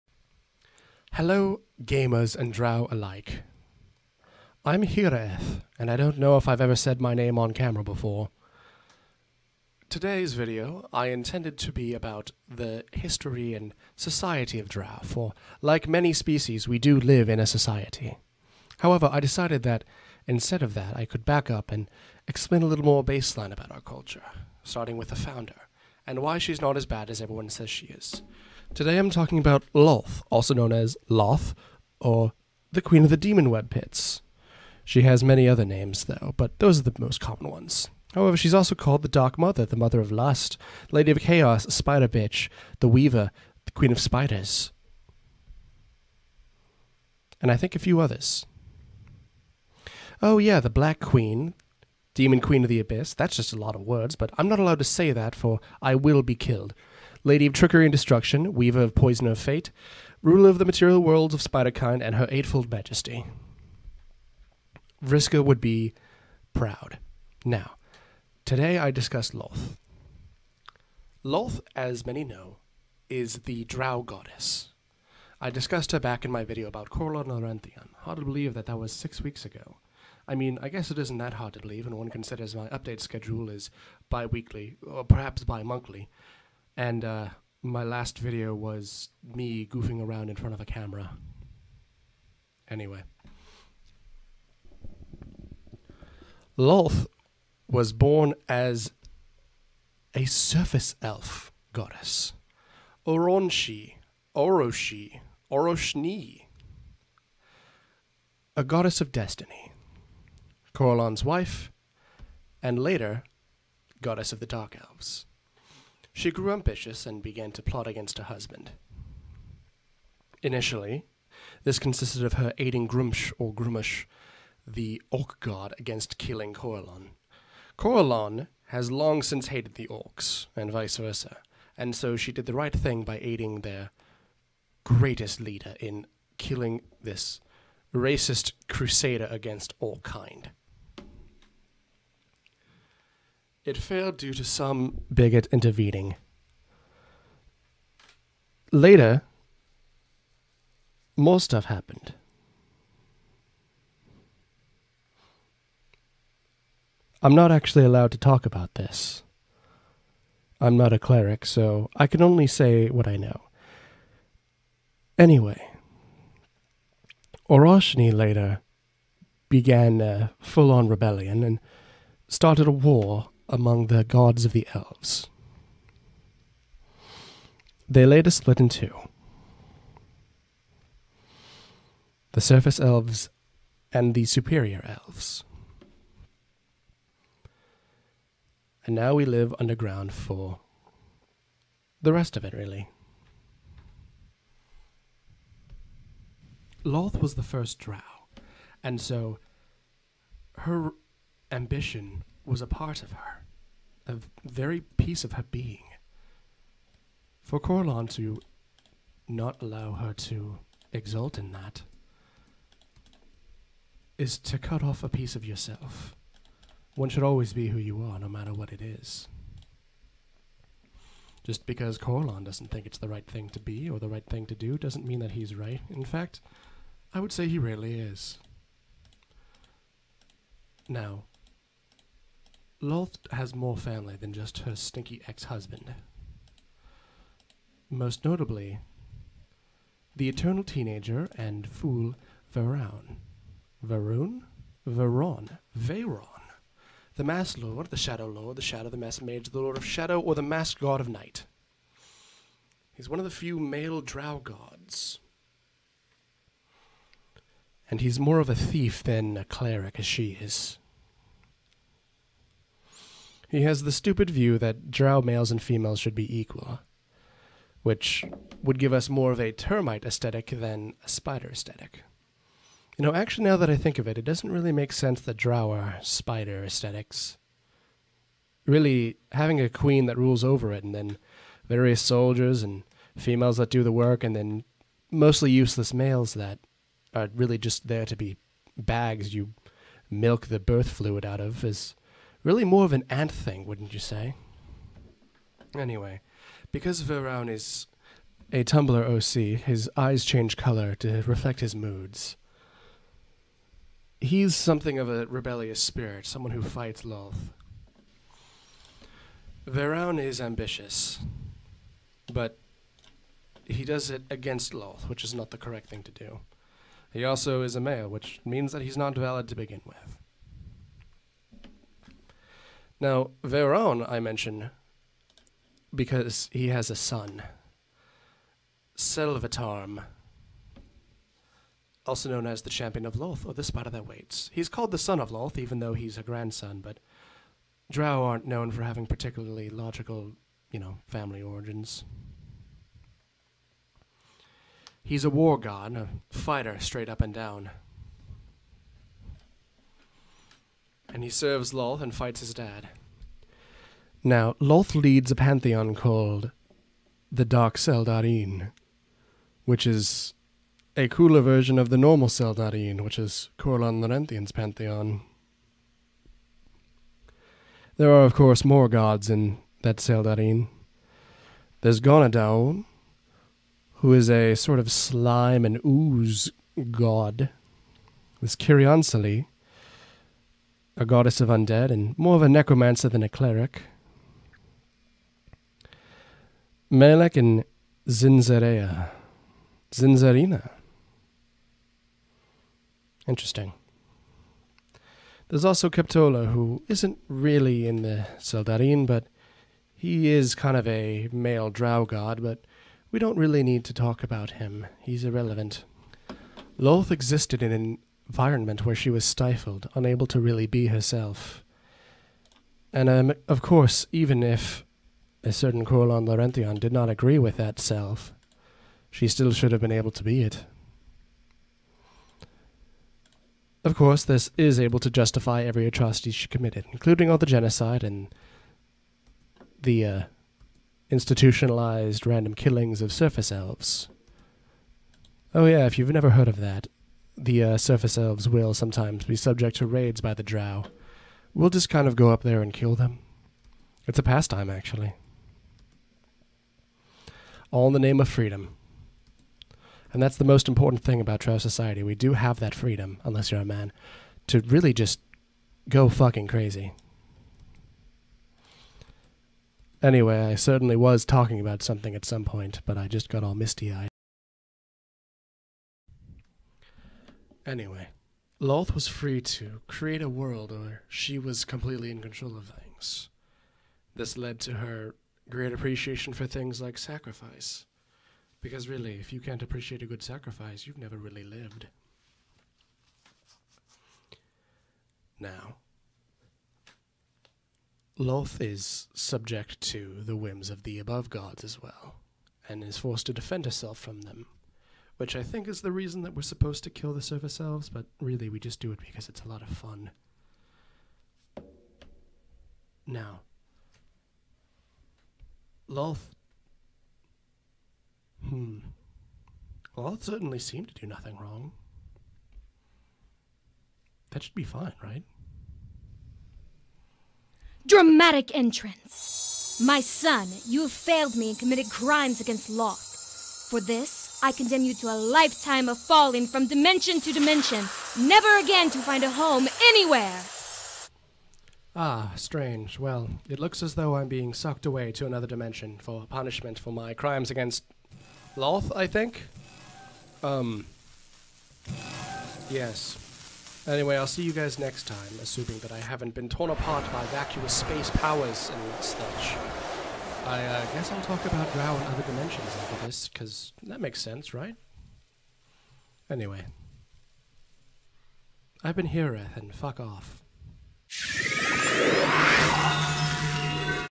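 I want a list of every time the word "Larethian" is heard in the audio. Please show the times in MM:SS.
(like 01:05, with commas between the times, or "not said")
01:17, 06:04, 06:56.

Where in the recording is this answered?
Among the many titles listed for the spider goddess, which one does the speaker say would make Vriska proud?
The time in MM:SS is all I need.
01:02.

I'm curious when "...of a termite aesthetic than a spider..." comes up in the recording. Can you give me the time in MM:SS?
04:29.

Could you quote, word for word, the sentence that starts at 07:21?
We'll just kind of go up there and kill them.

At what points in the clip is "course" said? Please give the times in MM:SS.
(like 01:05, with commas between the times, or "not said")
06:08, 06:53, 07:03.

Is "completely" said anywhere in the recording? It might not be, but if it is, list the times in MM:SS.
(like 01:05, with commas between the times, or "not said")
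07:51.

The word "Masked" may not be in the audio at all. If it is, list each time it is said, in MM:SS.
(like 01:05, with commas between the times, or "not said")
04:10.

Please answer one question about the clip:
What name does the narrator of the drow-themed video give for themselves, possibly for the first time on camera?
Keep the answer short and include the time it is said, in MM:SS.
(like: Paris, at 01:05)
Hireth, at 00:04.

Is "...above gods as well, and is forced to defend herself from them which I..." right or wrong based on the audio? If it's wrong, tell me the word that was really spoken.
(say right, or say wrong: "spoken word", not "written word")
right.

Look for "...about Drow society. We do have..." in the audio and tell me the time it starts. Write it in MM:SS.
07:31.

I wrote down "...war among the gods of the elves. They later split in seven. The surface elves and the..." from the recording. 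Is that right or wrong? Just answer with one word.
wrong.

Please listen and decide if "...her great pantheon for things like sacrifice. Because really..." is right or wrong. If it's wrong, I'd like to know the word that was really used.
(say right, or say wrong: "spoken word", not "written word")
wrong: "appreciation", not "pantheon".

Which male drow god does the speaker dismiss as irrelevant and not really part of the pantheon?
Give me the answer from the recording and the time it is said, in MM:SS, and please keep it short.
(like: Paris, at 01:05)
Keptolo, at 06:35.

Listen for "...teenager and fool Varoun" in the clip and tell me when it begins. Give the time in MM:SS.
04:00.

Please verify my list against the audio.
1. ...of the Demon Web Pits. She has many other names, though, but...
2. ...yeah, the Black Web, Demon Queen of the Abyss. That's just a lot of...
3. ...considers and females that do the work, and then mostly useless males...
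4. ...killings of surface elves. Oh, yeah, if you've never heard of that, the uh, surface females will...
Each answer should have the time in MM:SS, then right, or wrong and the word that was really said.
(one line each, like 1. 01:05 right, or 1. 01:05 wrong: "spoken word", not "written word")
1. 00:33 right
2. 00:50 wrong: "Queen", not "Web"
3. 04:42 wrong: "soldiers", not "considers"
4. 07:12 wrong: "elves", not "females".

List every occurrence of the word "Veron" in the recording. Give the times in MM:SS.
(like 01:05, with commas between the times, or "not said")
04:57, 05:09, 05:23.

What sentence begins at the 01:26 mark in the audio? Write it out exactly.
And uh, my last video was me goofing around in front of a camera.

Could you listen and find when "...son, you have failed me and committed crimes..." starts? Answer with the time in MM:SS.
08:40.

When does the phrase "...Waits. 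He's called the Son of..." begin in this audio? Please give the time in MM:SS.
05:34.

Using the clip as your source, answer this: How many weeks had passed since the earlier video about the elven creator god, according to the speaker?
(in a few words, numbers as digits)
6.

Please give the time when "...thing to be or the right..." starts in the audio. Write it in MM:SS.
03:43.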